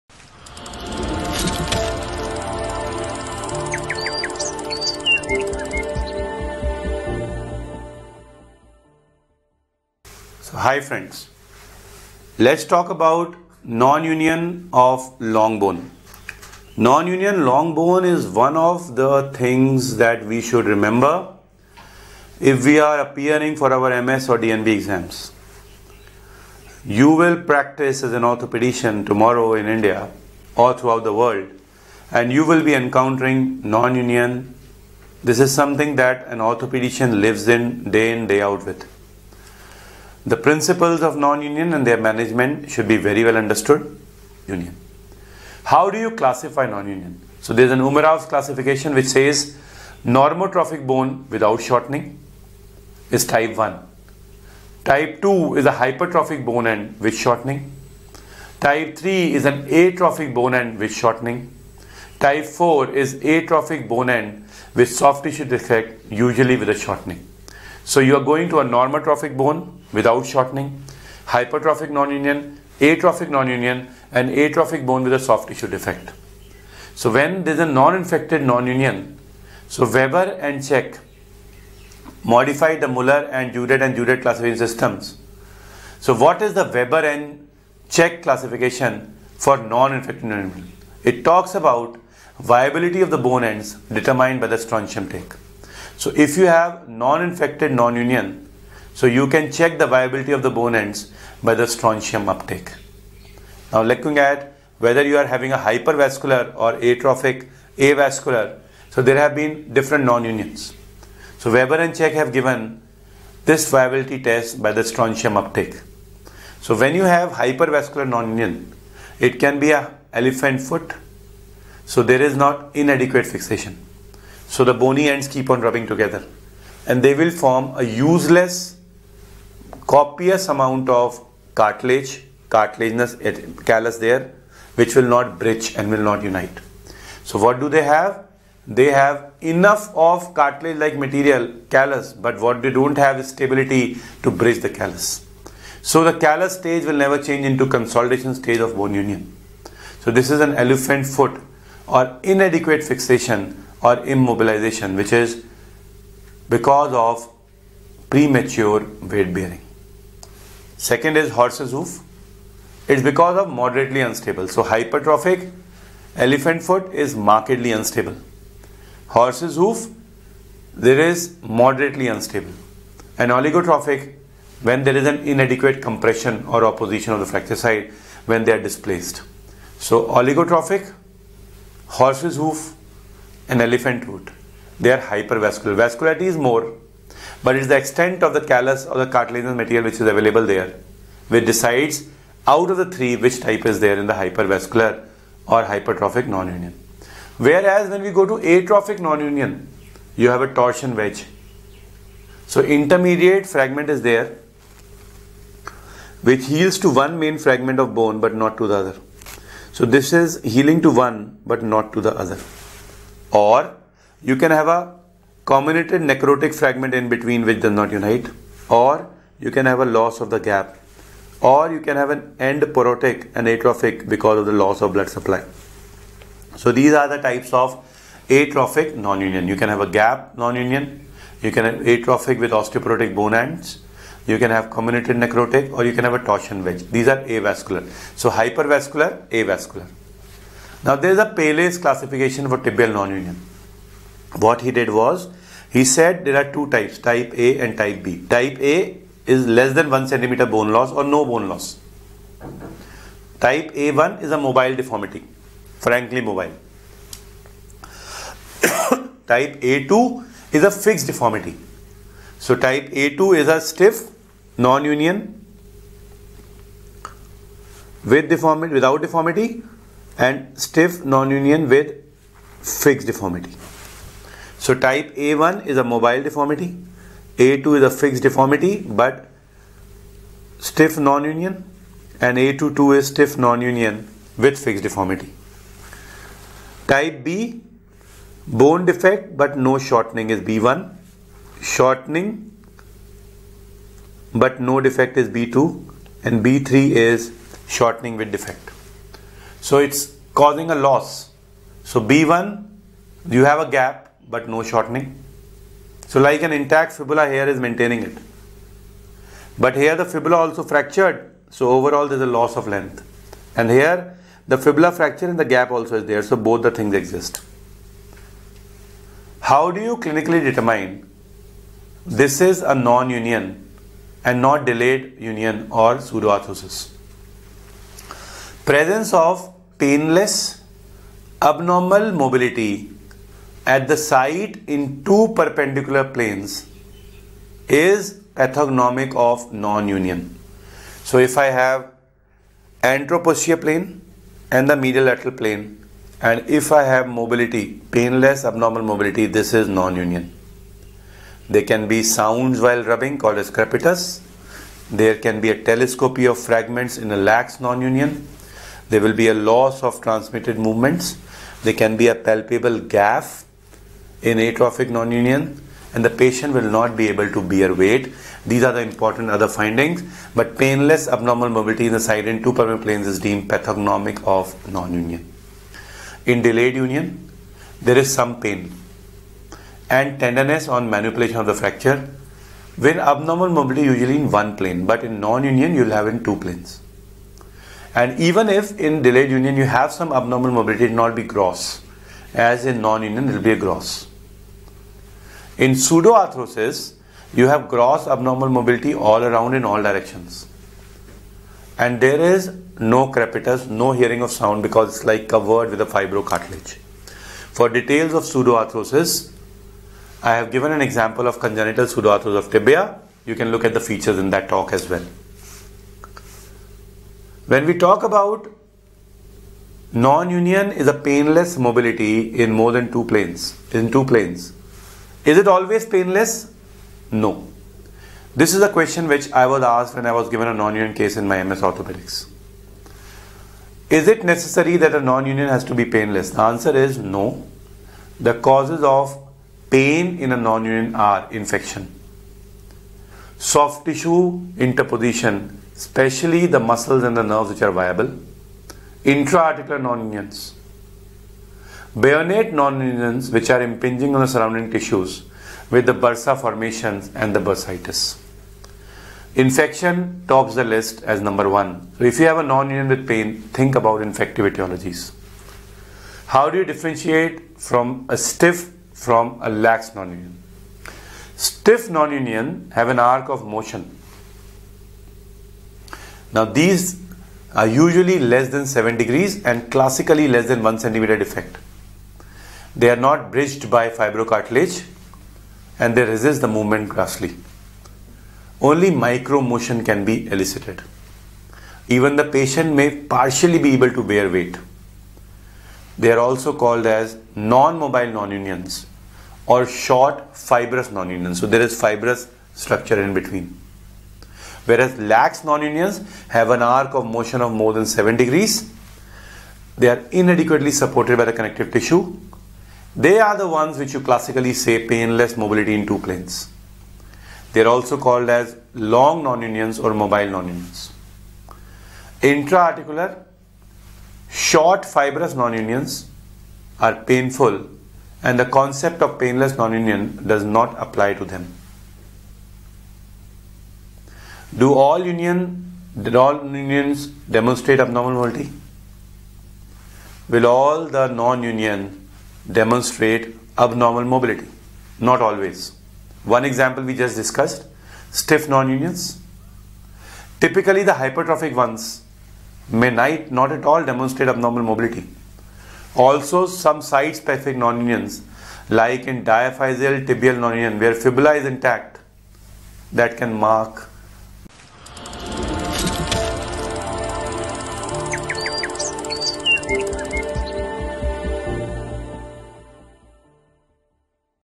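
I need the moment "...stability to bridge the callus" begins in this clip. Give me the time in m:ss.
2:23.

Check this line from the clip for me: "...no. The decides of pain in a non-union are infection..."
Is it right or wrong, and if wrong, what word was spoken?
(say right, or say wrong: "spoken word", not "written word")
wrong: "causes", not "decides".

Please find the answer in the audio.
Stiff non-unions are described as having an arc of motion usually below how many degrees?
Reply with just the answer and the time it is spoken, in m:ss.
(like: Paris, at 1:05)
7, at 7:58.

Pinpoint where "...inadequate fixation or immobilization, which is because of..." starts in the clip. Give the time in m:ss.
2:32.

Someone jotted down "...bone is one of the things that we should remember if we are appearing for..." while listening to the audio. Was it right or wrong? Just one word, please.
right.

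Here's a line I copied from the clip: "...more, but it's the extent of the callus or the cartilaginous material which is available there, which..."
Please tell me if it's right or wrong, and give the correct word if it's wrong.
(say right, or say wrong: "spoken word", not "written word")
right.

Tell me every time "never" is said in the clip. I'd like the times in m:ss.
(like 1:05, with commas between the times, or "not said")
2:27.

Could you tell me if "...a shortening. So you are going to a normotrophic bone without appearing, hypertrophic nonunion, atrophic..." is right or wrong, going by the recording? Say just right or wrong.
wrong.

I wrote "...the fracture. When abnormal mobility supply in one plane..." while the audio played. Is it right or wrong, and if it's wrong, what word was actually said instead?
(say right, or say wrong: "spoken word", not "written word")
wrong: "usually", not "supply".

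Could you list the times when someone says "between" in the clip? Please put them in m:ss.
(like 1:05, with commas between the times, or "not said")
3:37, 8:23.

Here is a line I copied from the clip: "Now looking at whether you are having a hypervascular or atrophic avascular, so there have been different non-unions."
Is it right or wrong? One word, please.
right.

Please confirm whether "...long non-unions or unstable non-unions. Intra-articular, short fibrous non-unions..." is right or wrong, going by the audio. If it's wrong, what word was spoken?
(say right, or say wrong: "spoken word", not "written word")
wrong: "mobile", not "unstable".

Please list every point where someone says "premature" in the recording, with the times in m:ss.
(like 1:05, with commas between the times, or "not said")
2:38.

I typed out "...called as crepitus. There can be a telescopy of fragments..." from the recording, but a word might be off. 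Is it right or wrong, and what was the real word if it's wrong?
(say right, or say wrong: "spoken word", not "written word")
right.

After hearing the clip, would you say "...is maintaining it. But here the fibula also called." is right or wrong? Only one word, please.
wrong.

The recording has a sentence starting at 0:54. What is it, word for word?
Type 2 is a hypertrophic bone end with shortening.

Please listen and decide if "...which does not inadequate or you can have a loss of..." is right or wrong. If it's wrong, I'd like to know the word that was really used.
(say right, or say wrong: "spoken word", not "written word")
wrong: "unite", not "inadequate".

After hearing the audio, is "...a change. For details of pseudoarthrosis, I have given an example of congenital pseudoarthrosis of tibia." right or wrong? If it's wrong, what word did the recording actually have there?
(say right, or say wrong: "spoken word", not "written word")
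wrong: "fibrocartilage", not "change".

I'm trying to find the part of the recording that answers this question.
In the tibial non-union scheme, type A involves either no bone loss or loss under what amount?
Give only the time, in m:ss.
4:09.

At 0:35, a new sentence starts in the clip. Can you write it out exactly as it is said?
This is something that an orthopedician lives in day in, day out with.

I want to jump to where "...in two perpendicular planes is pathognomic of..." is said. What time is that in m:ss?
5:34.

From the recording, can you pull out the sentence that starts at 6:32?
As in non-union, it will be a gross.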